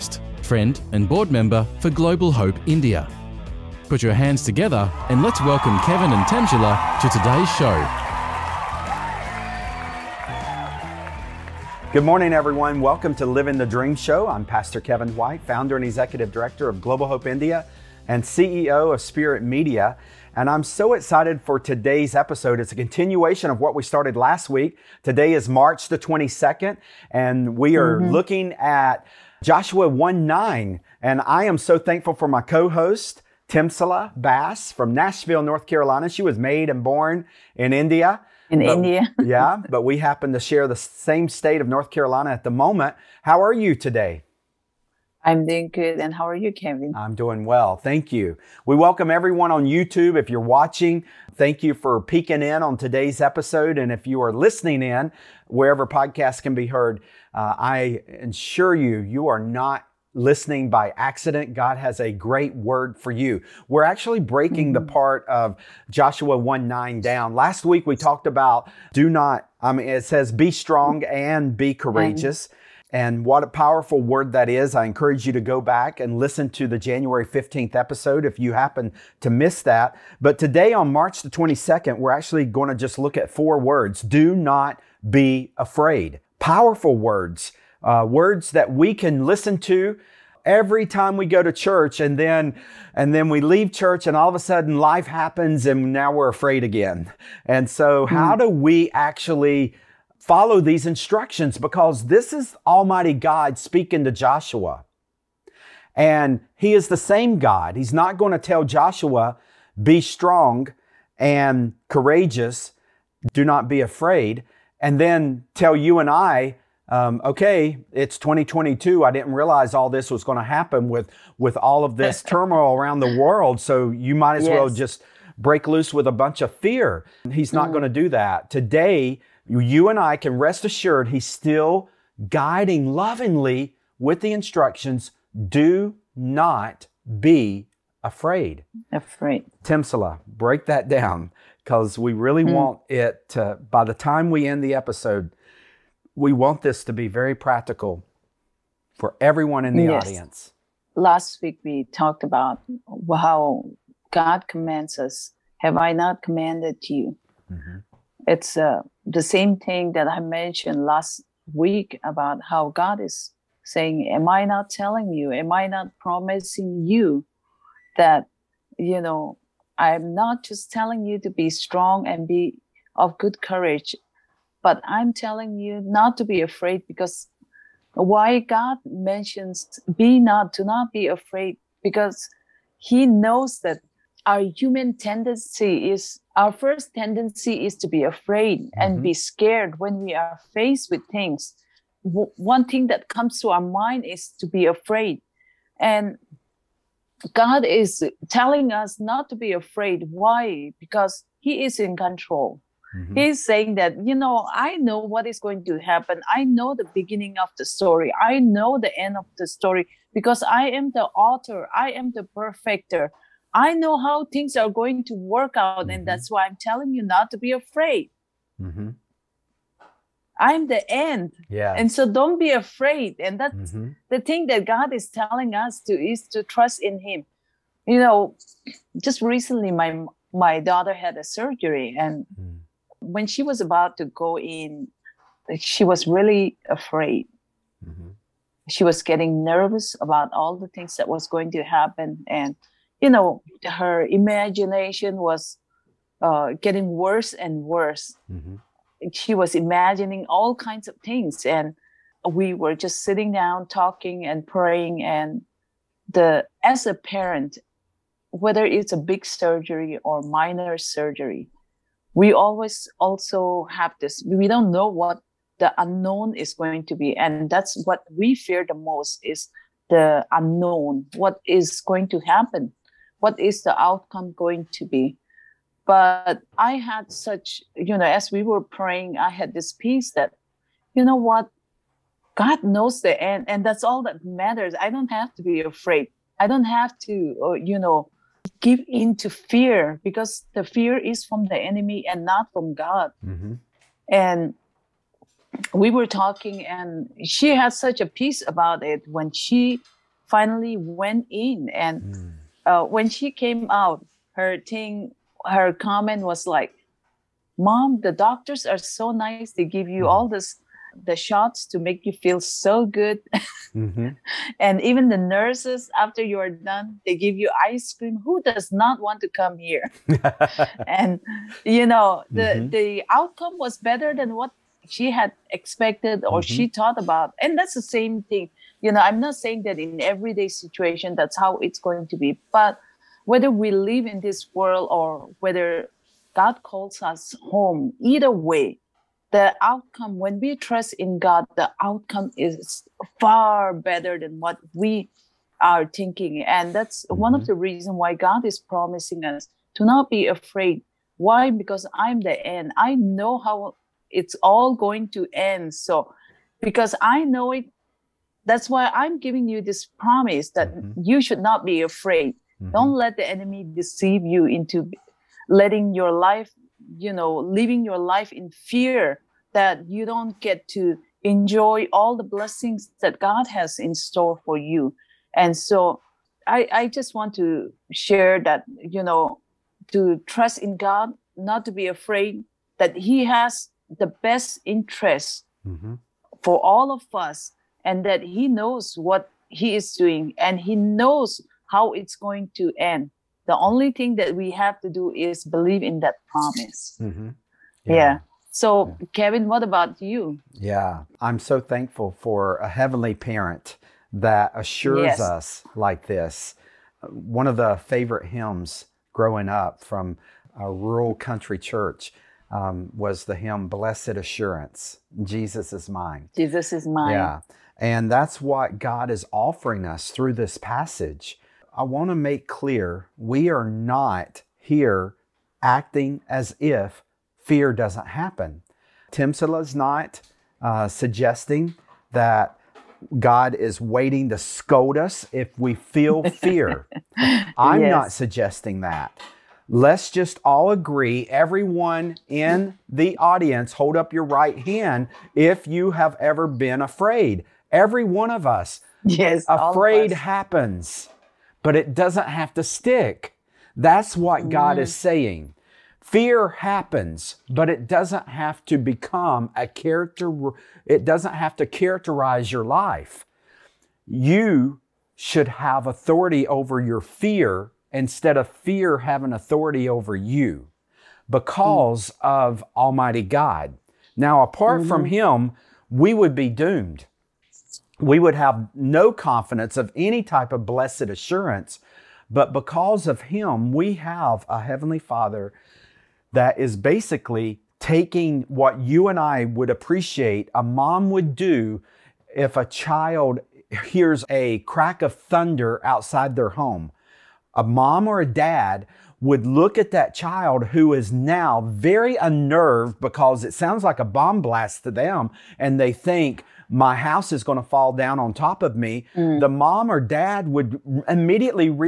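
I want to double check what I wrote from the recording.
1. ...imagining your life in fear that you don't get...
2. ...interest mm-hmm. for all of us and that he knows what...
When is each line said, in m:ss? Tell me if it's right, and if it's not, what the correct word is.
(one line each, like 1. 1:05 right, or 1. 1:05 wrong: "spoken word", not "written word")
1. 6:07 wrong: "living", not "imagining"
2. 6:24 right.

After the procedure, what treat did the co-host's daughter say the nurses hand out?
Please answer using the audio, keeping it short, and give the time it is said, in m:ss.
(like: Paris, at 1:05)
Ice cream, at 5:17.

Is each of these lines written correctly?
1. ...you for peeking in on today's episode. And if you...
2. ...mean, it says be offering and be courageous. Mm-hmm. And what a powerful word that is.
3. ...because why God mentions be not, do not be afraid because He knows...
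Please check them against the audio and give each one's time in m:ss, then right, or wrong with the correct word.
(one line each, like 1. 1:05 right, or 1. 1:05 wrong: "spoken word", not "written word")
1. 0:51 right
2. 1:09 wrong: "strong", not "offering"
3. 2:56 right.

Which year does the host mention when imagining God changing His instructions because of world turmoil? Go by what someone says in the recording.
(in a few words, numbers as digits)
2022.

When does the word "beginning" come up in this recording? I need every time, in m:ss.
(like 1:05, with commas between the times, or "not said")
3:26.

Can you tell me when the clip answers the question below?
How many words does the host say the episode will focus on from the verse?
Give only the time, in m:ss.
1:23.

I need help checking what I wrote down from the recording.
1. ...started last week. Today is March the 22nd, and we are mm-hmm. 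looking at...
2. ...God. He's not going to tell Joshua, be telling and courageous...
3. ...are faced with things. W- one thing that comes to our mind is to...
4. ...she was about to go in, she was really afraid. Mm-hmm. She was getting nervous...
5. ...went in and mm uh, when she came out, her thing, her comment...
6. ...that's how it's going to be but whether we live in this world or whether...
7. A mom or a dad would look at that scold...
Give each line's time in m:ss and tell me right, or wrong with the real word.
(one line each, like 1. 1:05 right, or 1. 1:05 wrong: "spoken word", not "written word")
1. 0:23 right
2. 1:47 wrong: "strong", not "telling"
3. 3:10 right
4. 3:53 right
5. 5:00 right
6. 5:31 right
7. 8:17 wrong: "child", not "scold".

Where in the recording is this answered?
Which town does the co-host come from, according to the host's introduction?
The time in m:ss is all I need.
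0:34.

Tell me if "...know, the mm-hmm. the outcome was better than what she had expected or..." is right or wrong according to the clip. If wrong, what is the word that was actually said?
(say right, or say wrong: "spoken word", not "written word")
right.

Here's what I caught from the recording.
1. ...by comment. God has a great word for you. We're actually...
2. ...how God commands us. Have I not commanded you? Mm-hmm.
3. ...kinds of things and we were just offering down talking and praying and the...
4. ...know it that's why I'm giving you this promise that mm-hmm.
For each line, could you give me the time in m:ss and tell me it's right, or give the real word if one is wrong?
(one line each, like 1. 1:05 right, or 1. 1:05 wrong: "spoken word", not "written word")
1. 1:00 wrong: "accident", not "comment"
2. 2:33 right
3. 4:10 wrong: "sitting", not "offering"
4. 5:57 right.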